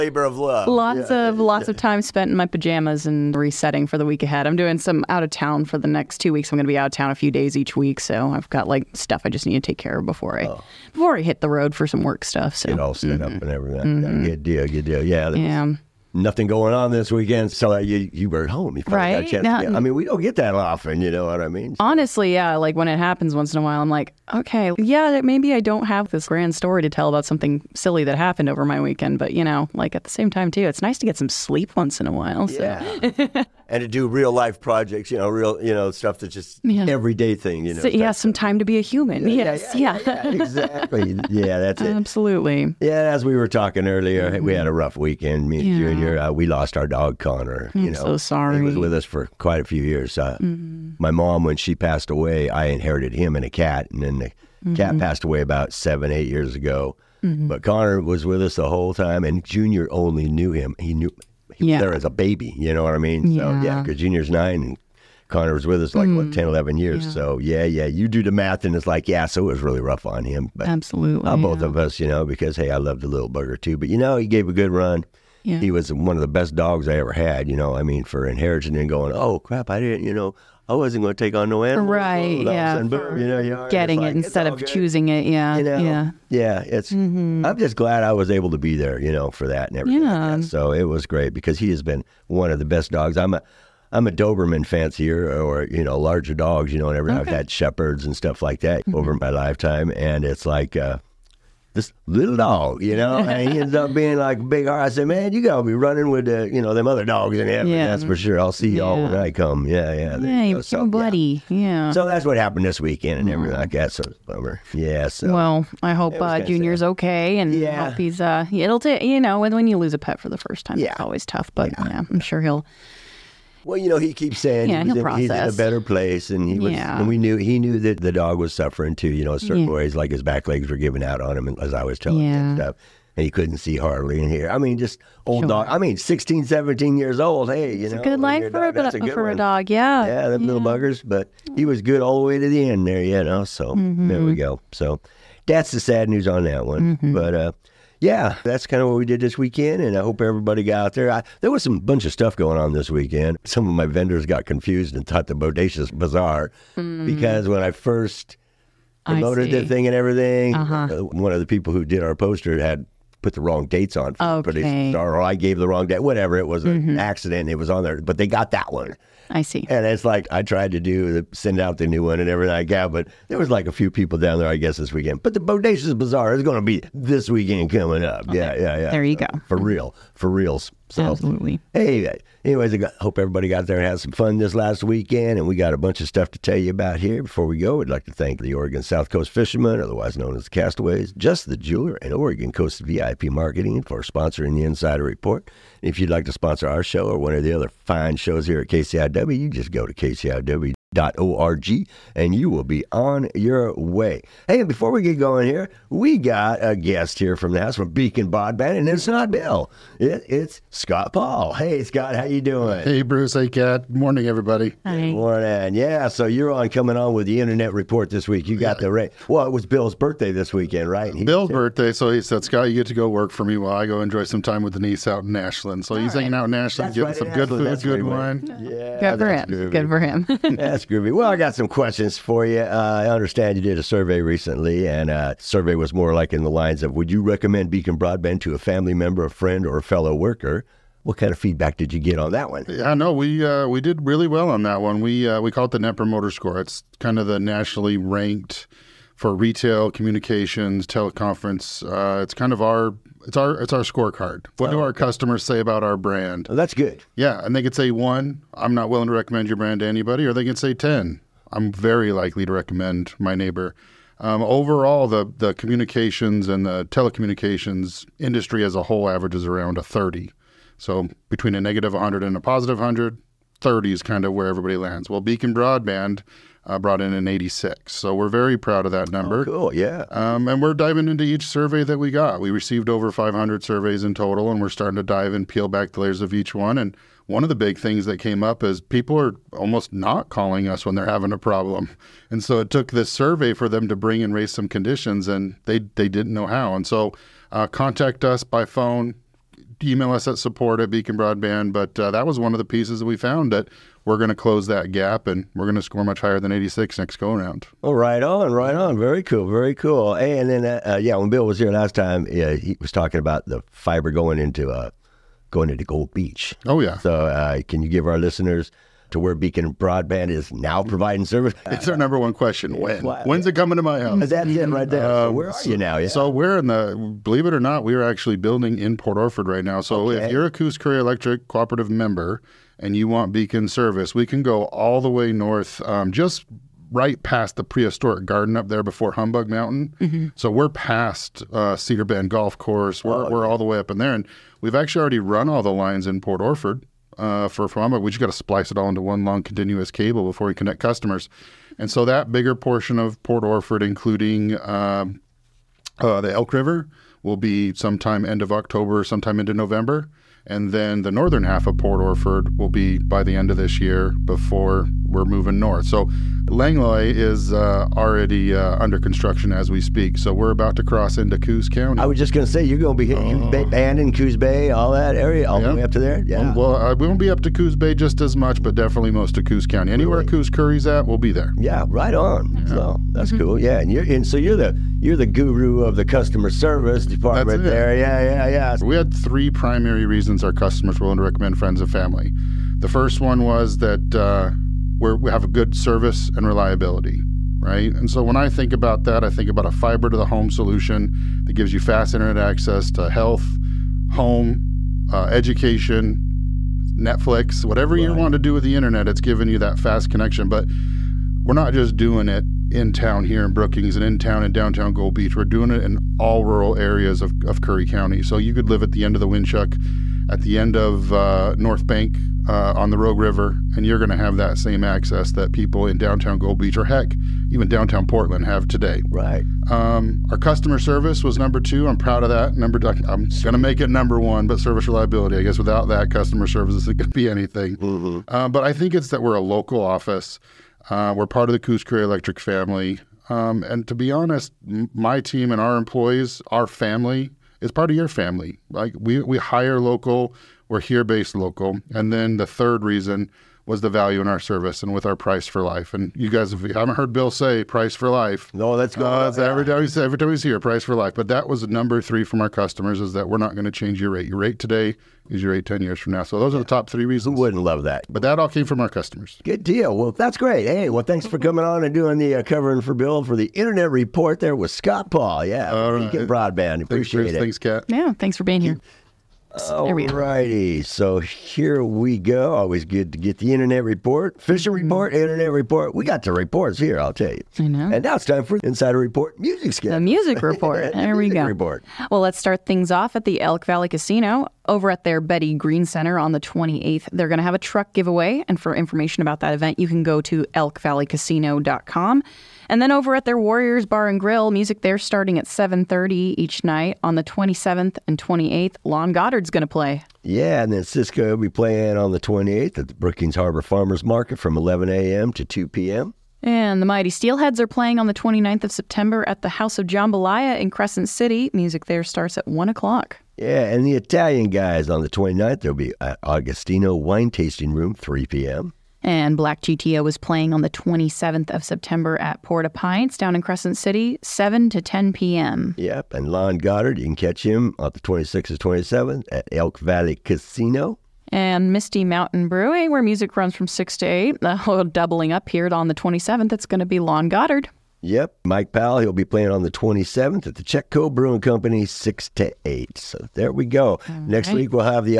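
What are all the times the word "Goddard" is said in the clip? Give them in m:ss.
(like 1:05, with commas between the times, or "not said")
8:29, 8:56, 9:07.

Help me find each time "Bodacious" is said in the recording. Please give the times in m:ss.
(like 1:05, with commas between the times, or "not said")
2:35, 2:55.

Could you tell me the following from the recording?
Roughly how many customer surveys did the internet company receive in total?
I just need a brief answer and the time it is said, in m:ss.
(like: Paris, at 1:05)
over 500, at 4:42.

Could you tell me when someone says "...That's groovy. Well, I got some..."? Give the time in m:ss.
3:50.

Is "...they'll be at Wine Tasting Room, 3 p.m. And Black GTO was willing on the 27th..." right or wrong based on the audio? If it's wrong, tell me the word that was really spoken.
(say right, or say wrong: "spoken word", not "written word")
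wrong: "playing", not "willing".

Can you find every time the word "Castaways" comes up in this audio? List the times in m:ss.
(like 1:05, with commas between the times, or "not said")
3:10.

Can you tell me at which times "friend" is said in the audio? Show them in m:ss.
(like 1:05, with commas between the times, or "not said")
3:59, 6:31.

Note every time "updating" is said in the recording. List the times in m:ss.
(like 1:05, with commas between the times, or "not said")
not said.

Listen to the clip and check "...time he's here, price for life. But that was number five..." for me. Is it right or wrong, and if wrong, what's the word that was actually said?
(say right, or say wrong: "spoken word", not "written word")
wrong: "three", not "five".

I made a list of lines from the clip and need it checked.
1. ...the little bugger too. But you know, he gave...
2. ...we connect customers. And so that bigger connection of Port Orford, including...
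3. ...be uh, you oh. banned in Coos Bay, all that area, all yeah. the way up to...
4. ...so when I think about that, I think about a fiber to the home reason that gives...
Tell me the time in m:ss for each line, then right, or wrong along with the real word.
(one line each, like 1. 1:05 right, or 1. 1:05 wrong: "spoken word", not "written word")
1. 1:13 right
2. 5:50 wrong: "portion", not "connection"
3. 6:13 right
4. 6:38 wrong: "solution", not "reason".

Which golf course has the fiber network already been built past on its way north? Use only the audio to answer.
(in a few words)
Cedar Bend Golf Course.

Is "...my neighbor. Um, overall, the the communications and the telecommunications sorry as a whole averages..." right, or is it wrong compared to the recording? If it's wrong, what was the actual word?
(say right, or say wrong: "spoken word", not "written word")
wrong: "industry", not "sorry".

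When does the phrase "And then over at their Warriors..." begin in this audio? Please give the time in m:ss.
8:22.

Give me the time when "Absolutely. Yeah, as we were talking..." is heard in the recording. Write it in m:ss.
0:41.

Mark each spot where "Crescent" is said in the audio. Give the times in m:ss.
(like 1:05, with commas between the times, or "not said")
8:40, 8:53.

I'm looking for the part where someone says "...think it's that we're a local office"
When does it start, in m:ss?
7:18.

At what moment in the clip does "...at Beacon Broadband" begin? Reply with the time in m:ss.
5:00.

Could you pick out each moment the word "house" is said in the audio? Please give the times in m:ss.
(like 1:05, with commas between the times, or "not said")
3:27, 5:23, 8:39.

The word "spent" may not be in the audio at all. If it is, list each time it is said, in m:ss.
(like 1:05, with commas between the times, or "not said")
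0:02.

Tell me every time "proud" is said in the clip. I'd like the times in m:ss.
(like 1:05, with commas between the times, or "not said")
4:38, 7:11.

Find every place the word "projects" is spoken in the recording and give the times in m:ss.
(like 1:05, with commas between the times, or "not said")
0:34.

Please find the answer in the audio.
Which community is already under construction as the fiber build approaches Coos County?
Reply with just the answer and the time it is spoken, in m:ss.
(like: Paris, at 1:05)
Langlois, at 6:06.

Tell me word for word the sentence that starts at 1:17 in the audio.
I mean, for inheriting and going, oh crap, I didn't, you know, I wasn't going to take on no animals.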